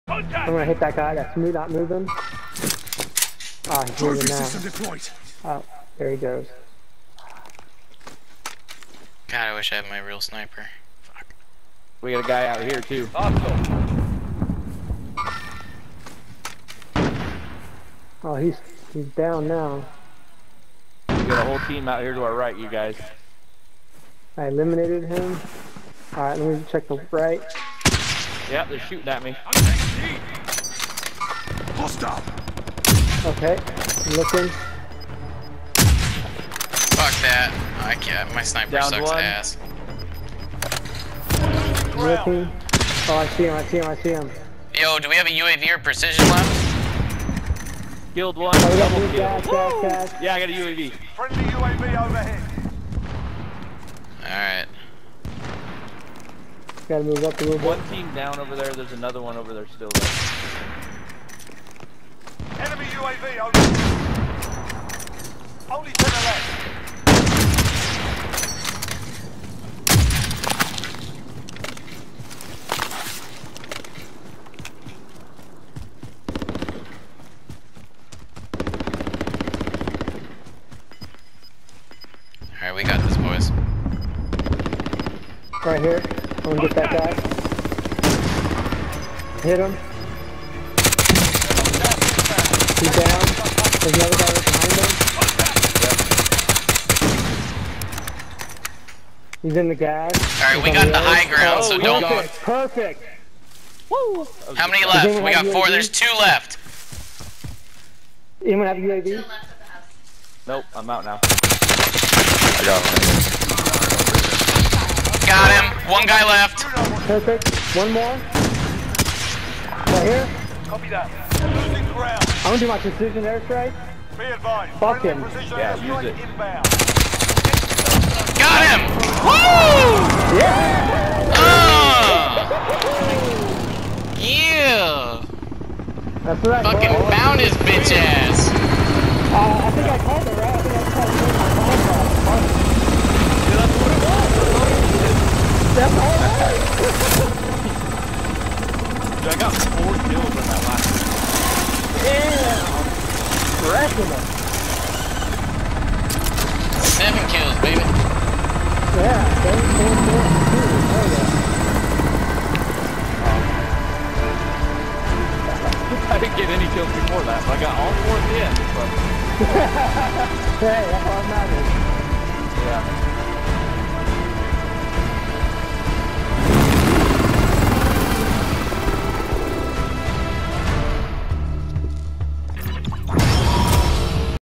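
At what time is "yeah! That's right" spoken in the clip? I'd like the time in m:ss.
2:14.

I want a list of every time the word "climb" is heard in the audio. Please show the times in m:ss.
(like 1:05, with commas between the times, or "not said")
not said.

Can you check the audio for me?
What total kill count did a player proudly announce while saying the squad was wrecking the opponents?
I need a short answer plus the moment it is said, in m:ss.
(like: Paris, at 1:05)
7, at 2:36.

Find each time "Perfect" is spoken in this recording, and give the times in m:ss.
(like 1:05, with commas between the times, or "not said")
1:42, 1:57.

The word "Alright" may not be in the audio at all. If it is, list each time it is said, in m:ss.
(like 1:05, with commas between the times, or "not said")
1:22, 1:40.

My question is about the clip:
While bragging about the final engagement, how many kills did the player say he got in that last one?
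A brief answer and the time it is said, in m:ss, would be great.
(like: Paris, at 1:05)
4, at 2:29.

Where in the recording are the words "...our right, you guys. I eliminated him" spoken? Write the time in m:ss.
0:22.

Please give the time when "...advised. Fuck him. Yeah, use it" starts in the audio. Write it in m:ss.
2:04.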